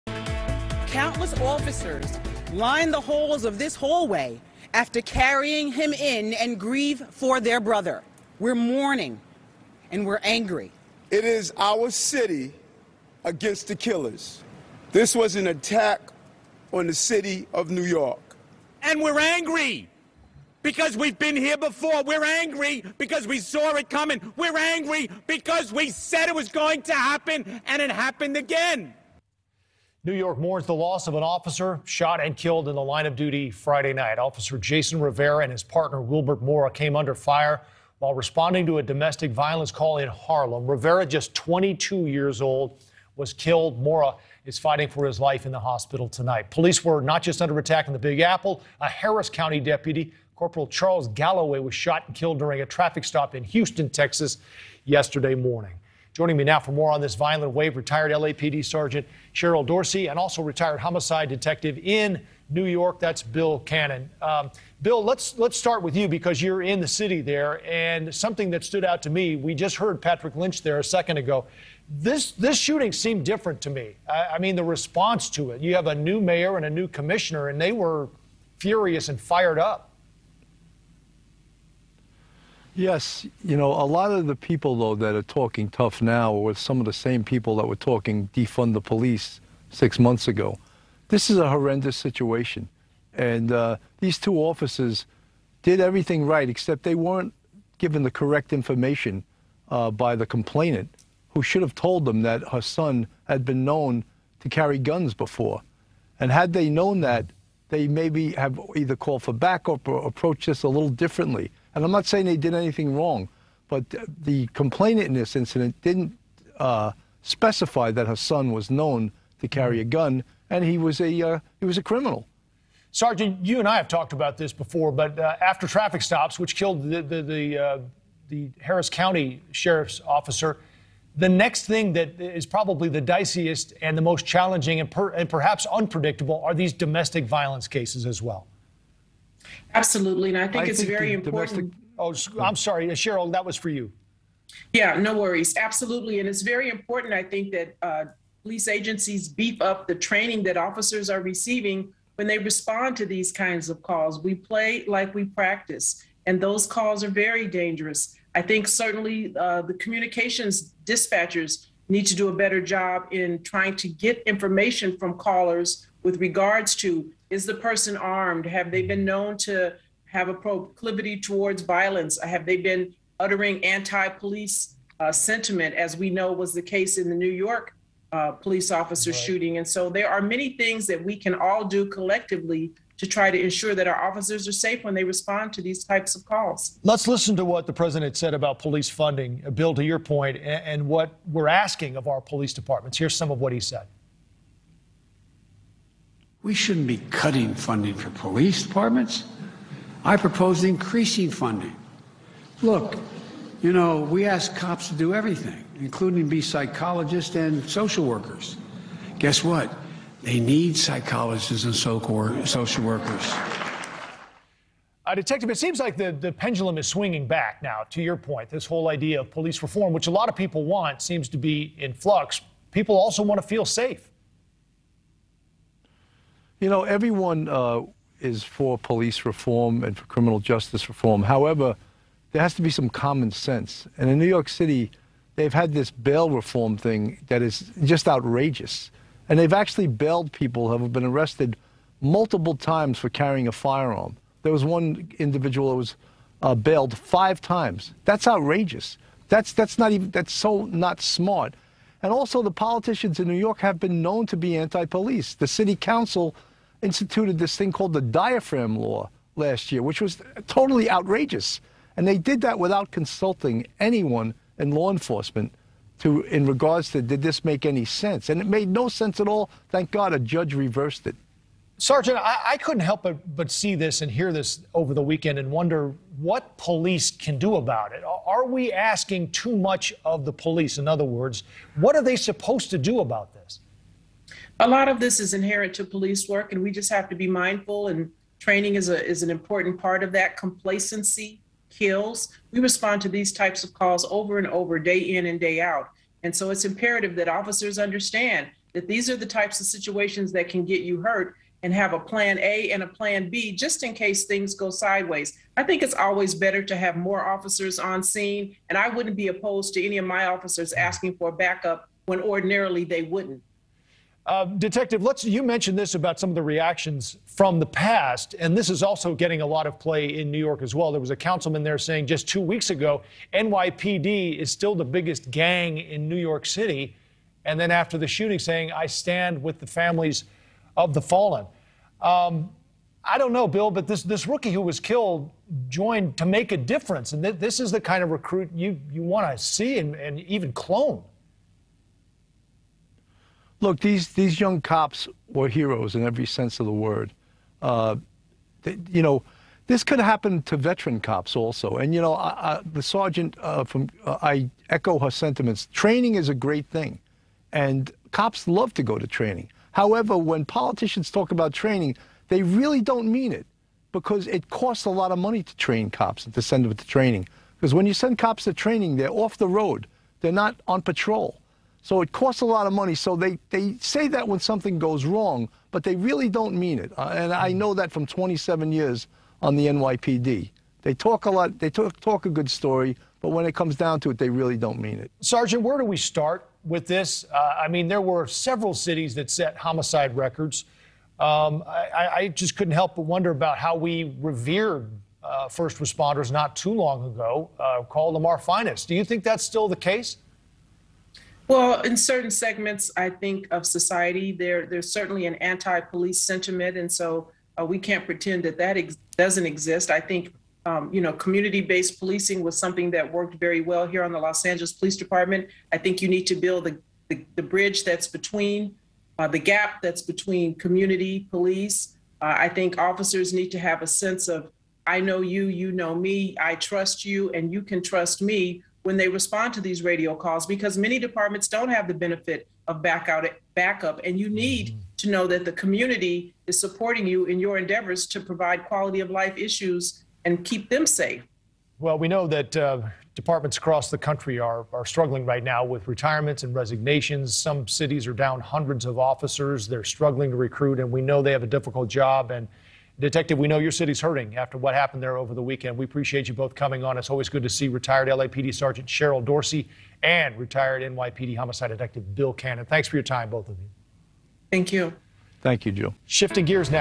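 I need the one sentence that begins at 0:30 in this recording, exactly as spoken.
New York mourns the loss of an officer shot and killed in the line of duty Friday night.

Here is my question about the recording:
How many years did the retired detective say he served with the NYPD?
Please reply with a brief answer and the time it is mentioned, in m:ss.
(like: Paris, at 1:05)
27, at 6:18.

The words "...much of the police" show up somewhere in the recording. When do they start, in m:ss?
4:39.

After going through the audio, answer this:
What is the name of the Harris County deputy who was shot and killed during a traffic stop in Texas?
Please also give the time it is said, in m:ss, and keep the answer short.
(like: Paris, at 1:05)
Charles Galloway, at 0:50.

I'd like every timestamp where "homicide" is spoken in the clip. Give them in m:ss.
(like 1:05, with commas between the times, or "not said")
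1:00, 6:29, 7:41.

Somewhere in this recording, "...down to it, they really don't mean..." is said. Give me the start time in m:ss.
6:23.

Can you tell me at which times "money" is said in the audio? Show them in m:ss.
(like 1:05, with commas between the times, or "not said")
6:05, 6:12.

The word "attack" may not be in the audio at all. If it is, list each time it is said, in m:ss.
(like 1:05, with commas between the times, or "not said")
0:15, 0:47.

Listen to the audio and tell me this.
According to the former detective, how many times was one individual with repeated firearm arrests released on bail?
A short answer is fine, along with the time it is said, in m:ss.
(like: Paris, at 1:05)
5, at 4:06.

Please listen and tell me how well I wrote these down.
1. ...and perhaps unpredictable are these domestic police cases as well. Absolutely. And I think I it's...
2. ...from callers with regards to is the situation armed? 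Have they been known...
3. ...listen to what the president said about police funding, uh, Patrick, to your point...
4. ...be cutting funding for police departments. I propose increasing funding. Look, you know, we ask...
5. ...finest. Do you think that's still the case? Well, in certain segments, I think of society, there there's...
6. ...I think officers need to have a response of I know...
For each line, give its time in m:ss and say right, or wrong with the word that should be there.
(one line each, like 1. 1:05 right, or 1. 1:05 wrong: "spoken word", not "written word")
1. 2:15 wrong: "violence", not "police"
2. 2:44 wrong: "person", not "situation"
3. 3:07 wrong: "Bill", not "Patrick"
4. 3:16 right
5. 6:38 right
6. 7:02 wrong: "sense", not "response".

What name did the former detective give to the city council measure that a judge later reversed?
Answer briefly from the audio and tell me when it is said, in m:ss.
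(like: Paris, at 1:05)
diaphragm law, at 4:18.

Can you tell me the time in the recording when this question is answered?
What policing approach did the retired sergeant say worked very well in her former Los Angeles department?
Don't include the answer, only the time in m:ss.
6:51.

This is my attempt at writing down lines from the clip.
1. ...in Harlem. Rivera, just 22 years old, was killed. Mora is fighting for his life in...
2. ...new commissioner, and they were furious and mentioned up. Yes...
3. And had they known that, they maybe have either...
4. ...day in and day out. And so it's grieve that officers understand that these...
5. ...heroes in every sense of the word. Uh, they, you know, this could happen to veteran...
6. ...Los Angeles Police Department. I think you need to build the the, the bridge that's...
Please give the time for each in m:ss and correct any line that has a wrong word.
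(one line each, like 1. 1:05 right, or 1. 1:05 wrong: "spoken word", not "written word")
1. 0:39 right
2. 1:16 wrong: "fired", not "mentioned"
3. 1:46 right
4. 4:54 wrong: "imperative", not "grieve"
5. 5:45 right
6. 6:54 right.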